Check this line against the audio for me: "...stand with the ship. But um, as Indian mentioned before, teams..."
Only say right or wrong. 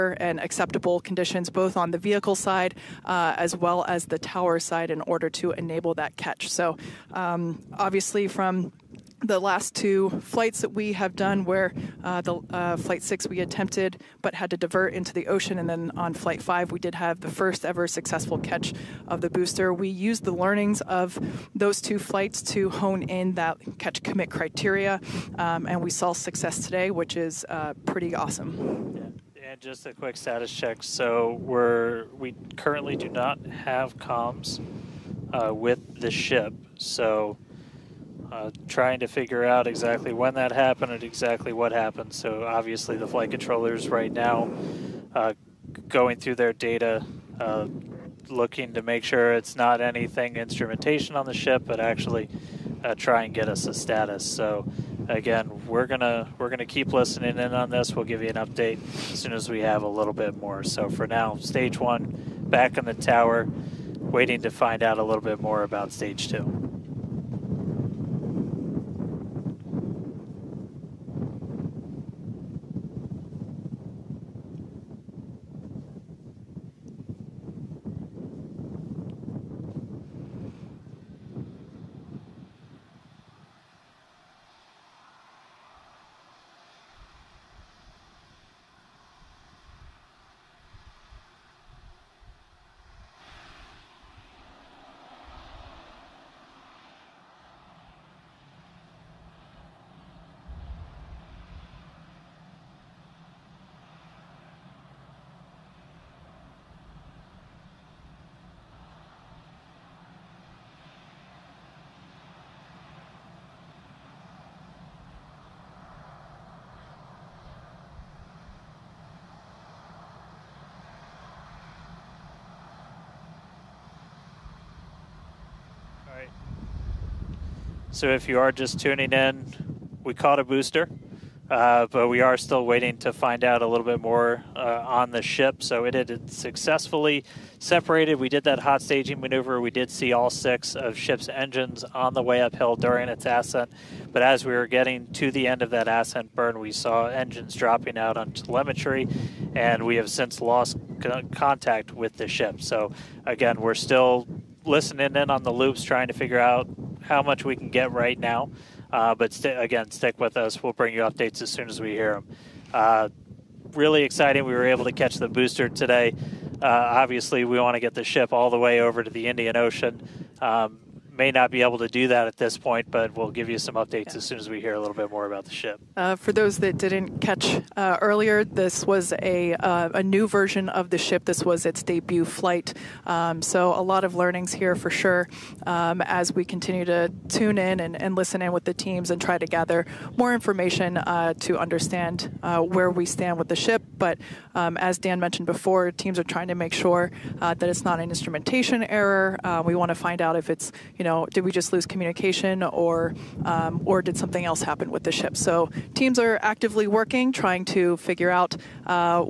wrong.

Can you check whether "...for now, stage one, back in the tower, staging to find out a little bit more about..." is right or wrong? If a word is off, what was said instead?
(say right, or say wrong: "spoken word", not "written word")
wrong: "waiting", not "staging".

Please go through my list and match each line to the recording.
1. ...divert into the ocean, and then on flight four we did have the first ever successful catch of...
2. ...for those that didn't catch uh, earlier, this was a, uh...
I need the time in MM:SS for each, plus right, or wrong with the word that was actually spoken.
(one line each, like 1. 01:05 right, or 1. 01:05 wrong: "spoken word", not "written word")
1. 00:14 wrong: "five", not "four"
2. 02:56 right.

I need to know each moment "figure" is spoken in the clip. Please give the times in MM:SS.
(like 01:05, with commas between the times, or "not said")
00:39, 02:36, 03:27.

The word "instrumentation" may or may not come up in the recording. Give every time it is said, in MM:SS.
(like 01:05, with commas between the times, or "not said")
00:50, 03:18.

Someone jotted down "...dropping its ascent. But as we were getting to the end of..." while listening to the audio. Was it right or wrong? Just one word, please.
wrong.